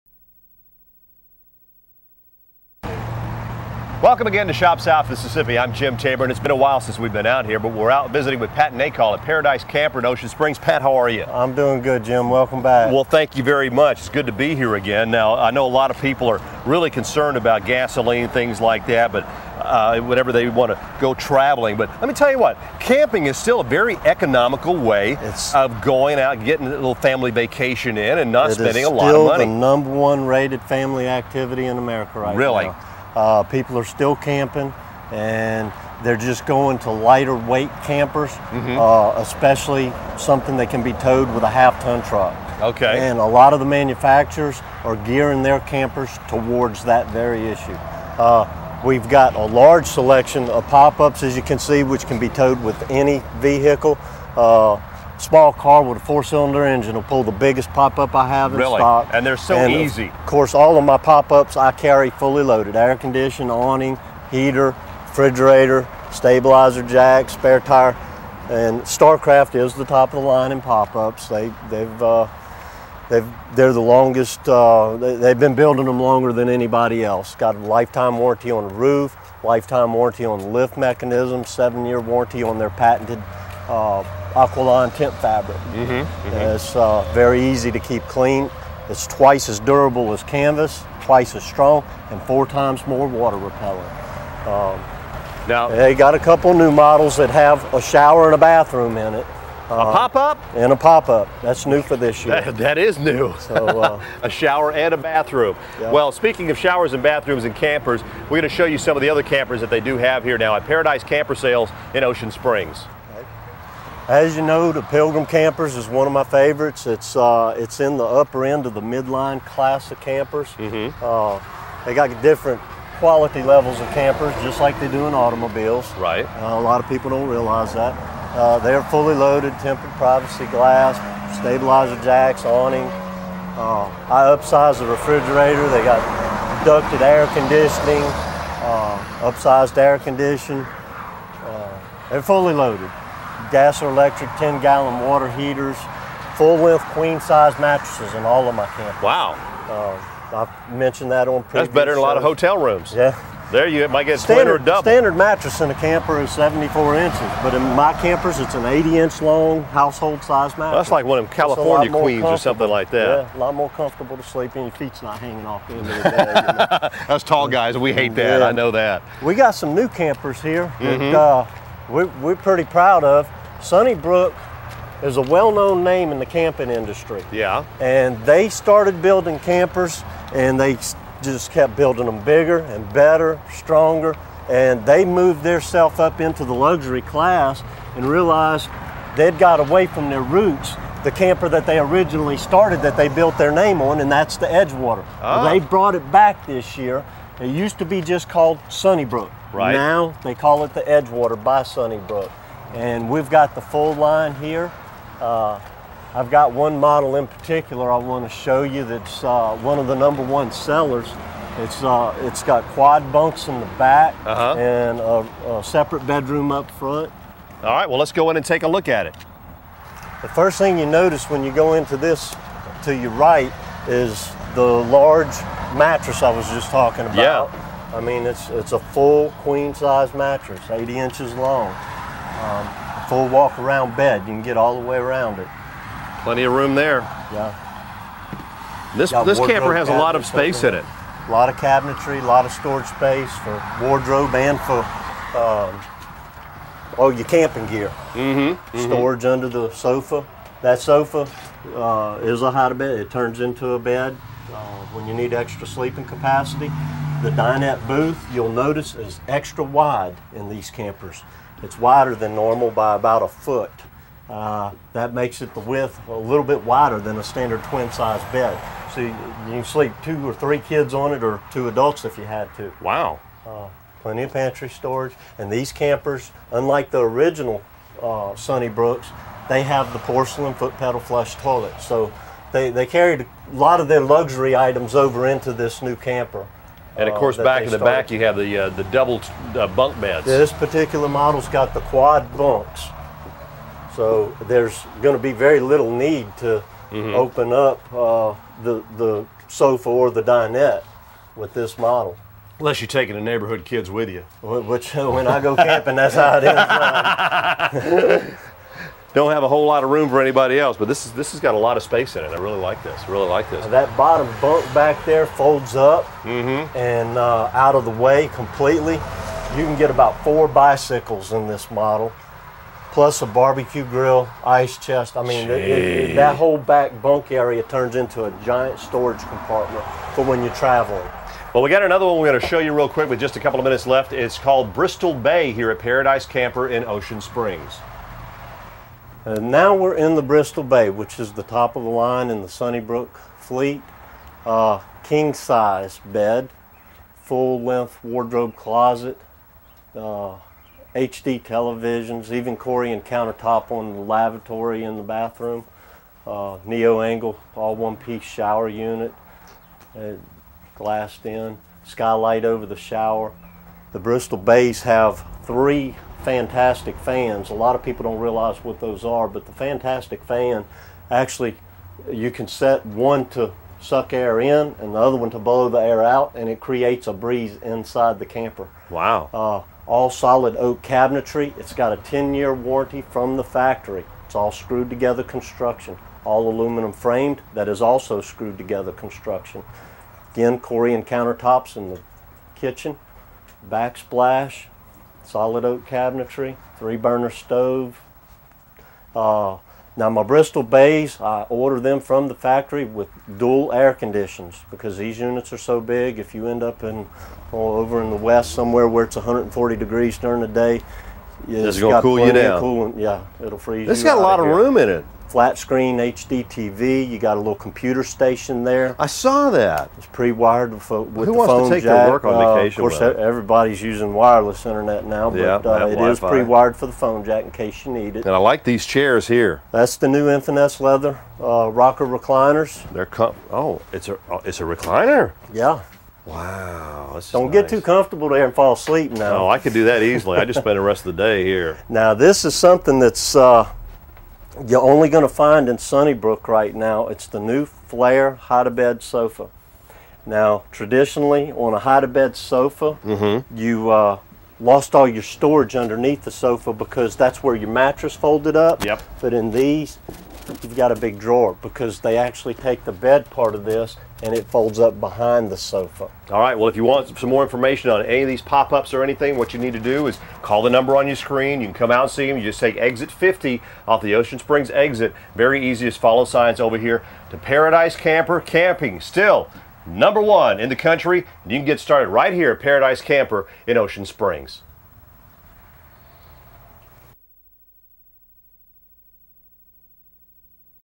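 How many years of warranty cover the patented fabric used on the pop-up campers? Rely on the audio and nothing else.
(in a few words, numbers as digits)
7.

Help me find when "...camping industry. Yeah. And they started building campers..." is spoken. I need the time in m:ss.
2:56.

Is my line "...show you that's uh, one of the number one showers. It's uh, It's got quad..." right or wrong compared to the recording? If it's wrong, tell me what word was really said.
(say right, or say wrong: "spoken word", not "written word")
wrong: "sellers", not "showers".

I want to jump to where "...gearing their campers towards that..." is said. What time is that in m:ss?
0:44.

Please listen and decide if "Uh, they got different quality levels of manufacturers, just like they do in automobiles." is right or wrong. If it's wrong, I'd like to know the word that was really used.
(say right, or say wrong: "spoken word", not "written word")
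wrong: "campers", not "manufacturers".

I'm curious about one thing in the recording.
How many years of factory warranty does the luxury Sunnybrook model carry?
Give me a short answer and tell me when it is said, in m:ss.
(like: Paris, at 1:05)
10, at 6:21.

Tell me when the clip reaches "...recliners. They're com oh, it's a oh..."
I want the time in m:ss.
7:12.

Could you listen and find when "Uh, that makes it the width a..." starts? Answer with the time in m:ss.
4:24.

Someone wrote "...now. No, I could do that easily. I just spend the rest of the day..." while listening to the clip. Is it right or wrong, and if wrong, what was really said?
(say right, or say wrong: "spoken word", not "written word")
right.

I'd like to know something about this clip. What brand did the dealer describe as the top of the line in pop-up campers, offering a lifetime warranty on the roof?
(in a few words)
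Starcraft.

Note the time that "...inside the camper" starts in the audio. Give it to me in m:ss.
6:17.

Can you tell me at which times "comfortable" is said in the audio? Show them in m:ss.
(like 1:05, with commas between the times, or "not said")
2:43, 7:17.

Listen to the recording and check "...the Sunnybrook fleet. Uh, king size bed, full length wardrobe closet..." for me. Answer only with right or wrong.
right.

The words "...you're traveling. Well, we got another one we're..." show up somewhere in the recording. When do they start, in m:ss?
5:30.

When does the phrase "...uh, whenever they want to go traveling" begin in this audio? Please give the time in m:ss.
0:19.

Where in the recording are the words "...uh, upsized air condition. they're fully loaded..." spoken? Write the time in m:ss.
2:18.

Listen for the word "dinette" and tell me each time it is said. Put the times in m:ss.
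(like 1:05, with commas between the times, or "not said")
4:17, 5:00.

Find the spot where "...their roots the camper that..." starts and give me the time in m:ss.
3:10.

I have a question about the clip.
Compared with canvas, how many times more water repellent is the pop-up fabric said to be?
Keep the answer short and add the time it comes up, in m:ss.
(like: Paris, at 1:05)
4, at 1:32.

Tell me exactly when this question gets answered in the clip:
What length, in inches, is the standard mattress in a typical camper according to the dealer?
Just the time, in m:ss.
2:36.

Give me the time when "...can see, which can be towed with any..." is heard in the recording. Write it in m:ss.
0:51.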